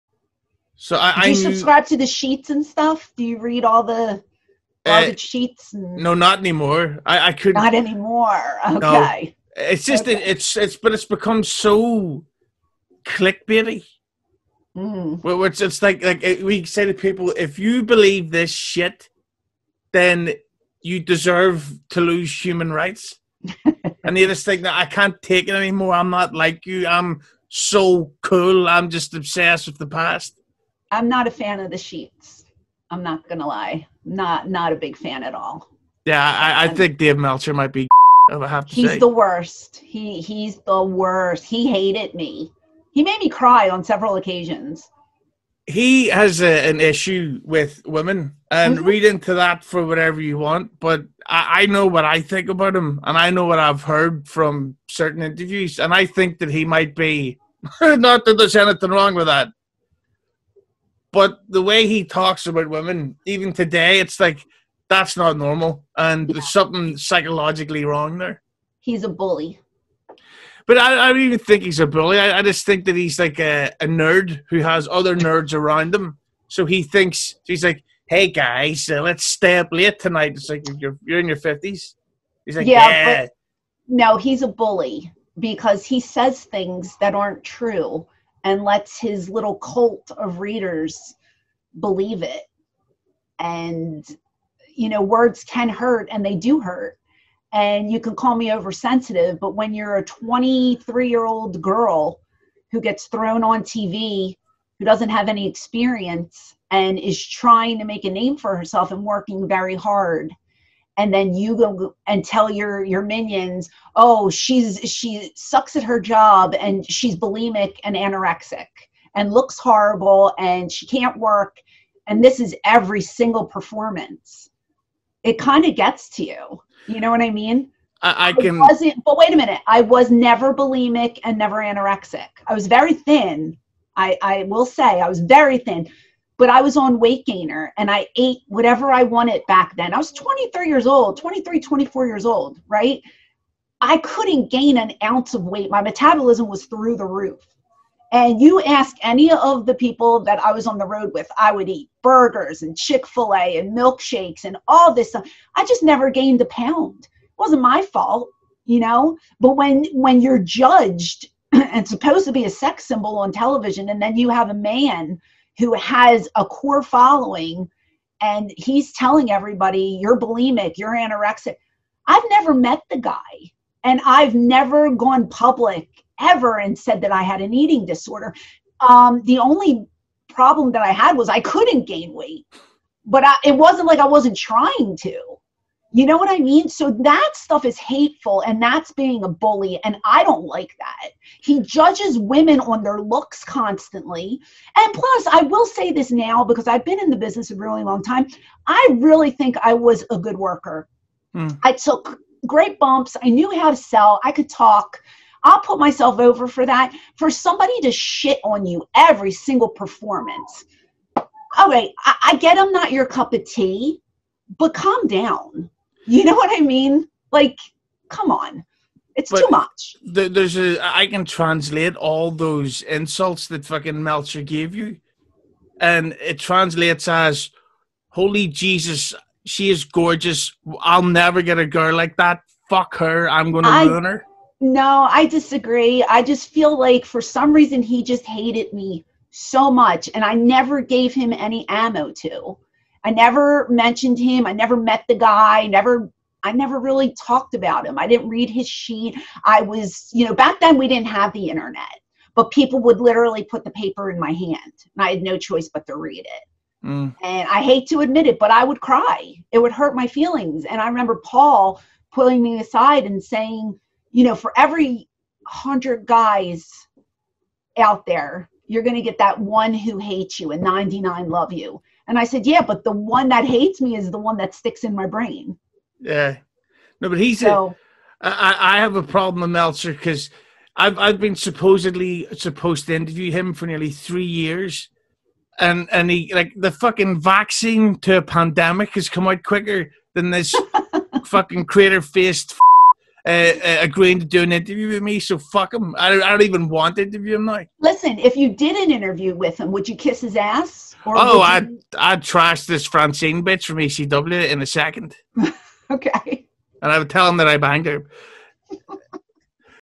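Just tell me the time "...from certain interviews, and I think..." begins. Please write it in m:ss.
0:54.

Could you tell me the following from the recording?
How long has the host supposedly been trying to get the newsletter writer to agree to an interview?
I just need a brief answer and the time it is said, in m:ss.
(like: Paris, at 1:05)
nearly three years, at 4:43.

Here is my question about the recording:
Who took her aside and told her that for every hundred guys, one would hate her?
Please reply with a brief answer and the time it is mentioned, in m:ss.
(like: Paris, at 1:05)
Paul, at 4:21.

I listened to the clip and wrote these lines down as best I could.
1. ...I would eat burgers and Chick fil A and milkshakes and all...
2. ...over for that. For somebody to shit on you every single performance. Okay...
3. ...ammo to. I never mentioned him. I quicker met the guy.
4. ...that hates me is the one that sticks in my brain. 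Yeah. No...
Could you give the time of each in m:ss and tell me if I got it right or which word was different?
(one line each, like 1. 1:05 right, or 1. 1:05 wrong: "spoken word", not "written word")
1. 2:31 right
2. 3:26 right
3. 4:01 wrong: "never", not "quicker"
4. 4:33 right.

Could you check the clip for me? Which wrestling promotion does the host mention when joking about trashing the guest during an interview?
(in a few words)
ECW.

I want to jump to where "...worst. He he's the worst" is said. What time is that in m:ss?
0:39.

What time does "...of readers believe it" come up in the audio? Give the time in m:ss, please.
1:30.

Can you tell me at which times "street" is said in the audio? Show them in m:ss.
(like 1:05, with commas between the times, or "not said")
not said.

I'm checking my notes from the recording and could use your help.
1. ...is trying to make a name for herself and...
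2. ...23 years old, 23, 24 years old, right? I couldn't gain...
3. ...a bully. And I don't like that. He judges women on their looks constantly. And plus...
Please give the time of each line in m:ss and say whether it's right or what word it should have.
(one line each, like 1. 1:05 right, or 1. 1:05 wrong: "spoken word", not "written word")
1. 1:46 right
2. 2:20 right
3. 3:09 right.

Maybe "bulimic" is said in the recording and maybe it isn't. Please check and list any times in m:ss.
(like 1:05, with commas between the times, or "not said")
1:57, 2:10, 2:50.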